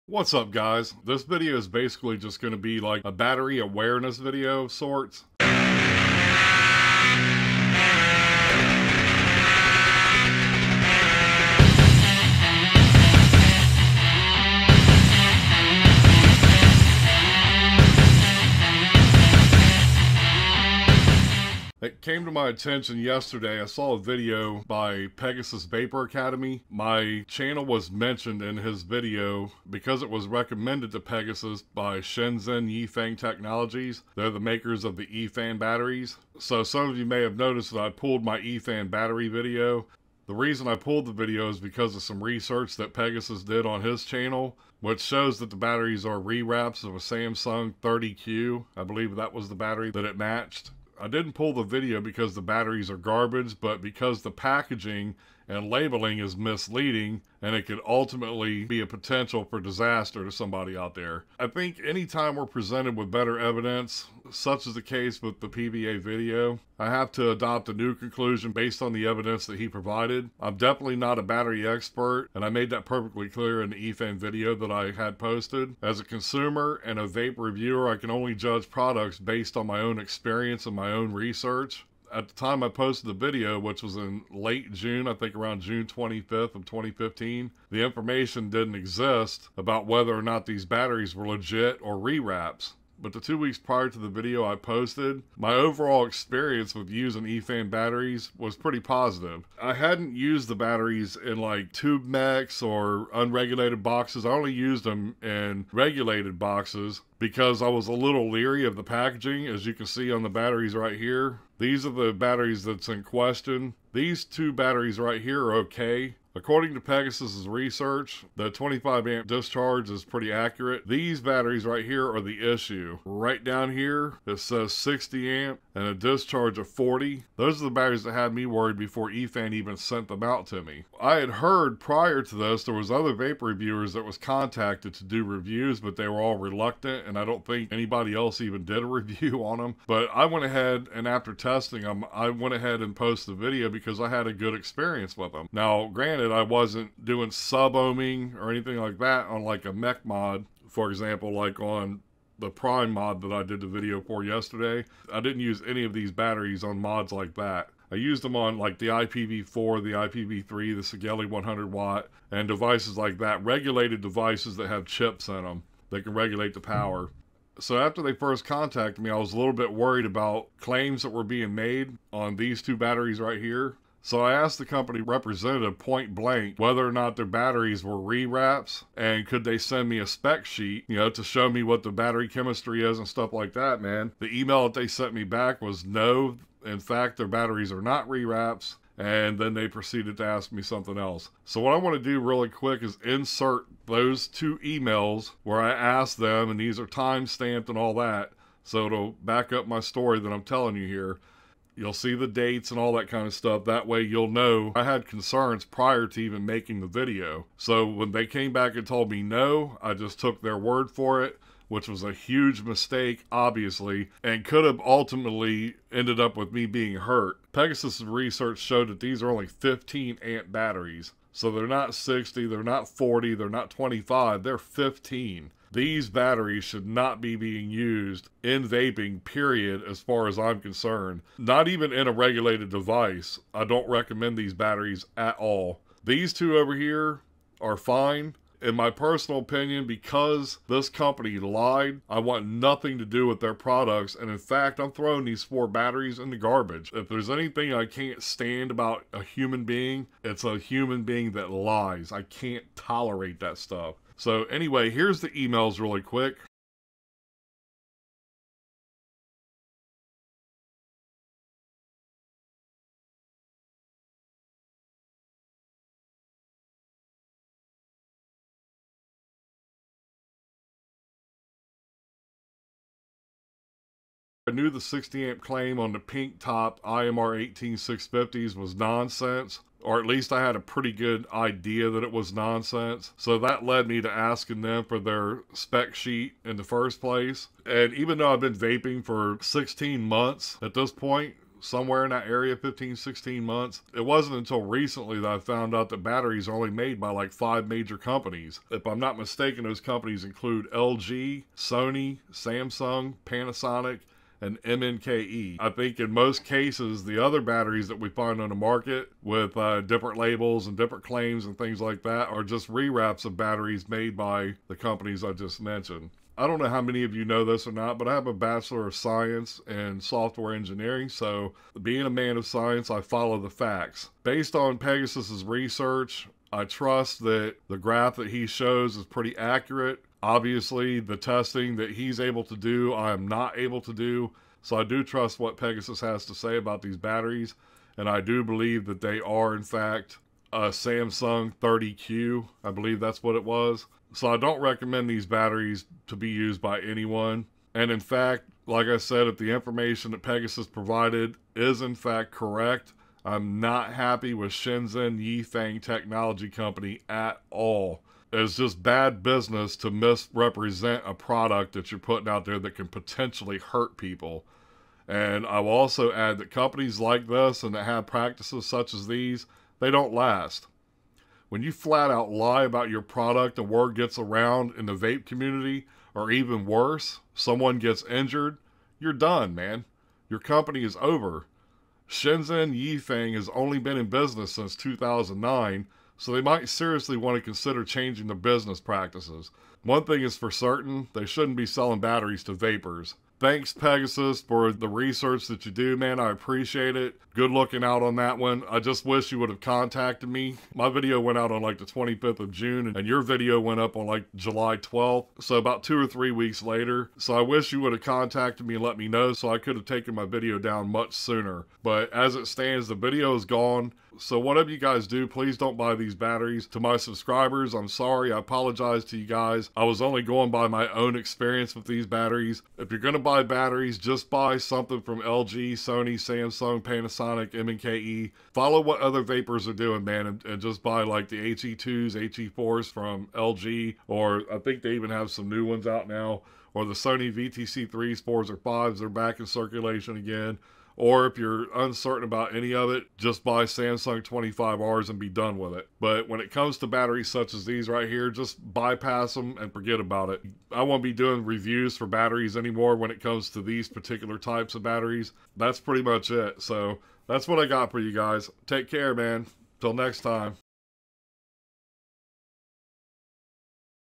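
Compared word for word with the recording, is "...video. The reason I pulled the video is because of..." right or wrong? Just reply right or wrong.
right.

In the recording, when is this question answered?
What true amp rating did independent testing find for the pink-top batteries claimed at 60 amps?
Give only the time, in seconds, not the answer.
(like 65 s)
224 s.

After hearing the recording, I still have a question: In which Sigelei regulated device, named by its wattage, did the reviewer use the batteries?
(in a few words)
Sigelei 100 watt.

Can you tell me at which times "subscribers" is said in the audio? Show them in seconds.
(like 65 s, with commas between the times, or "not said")
416 s.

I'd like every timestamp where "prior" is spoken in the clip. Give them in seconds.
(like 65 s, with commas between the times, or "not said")
93 s, 131 s, 205 s.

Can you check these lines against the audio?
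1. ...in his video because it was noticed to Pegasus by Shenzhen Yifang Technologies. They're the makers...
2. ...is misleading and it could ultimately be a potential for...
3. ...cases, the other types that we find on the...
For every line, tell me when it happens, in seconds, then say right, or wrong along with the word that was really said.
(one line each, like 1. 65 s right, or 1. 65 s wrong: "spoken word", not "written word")
1. 28 s wrong: "recommended", not "noticed"
2. 56 s right
3. 306 s wrong: "batteries", not "types".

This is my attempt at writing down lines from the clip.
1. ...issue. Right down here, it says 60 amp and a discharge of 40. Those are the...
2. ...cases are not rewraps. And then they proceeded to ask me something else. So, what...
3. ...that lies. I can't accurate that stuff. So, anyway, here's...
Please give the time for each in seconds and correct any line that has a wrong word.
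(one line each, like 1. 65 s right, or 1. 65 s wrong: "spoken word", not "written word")
1. 122 s right
2. 187 s wrong: "batteries", not "cases"
3. 251 s wrong: "tolerate", not "accurate".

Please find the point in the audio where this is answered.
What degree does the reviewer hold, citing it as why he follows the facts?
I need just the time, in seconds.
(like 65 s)
318 s.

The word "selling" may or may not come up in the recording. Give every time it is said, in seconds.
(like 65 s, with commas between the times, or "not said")
391 s.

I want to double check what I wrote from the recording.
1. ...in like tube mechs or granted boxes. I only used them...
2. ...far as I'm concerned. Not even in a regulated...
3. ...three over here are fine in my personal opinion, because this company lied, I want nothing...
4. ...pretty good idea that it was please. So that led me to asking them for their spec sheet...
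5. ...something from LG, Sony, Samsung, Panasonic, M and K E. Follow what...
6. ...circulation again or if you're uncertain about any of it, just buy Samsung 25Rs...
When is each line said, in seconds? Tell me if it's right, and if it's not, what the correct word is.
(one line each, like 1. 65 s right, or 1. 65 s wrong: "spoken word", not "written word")
1. 101 s wrong: "unregulated", not "granted"
2. 230 s right
3. 236 s wrong: "two", not "three"
4. 280 s wrong: "nonsense", not "please"
5. 424 s right
6. 439 s right.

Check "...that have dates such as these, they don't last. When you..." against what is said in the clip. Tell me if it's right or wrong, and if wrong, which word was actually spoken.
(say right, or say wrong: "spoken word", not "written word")
wrong: "practices", not "dates".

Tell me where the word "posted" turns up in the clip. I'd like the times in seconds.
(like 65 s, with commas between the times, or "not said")
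75 s, 82 s, 94 s, 142 s.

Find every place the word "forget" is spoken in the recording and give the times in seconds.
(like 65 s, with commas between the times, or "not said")
449 s.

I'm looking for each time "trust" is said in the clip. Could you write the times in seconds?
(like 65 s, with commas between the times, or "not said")
326 s, 335 s.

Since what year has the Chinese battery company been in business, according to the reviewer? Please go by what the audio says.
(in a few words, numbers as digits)
2009.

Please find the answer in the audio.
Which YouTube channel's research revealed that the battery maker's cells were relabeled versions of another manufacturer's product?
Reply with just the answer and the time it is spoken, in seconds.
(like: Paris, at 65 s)
Pegasus Vapor Academy, at 25 s.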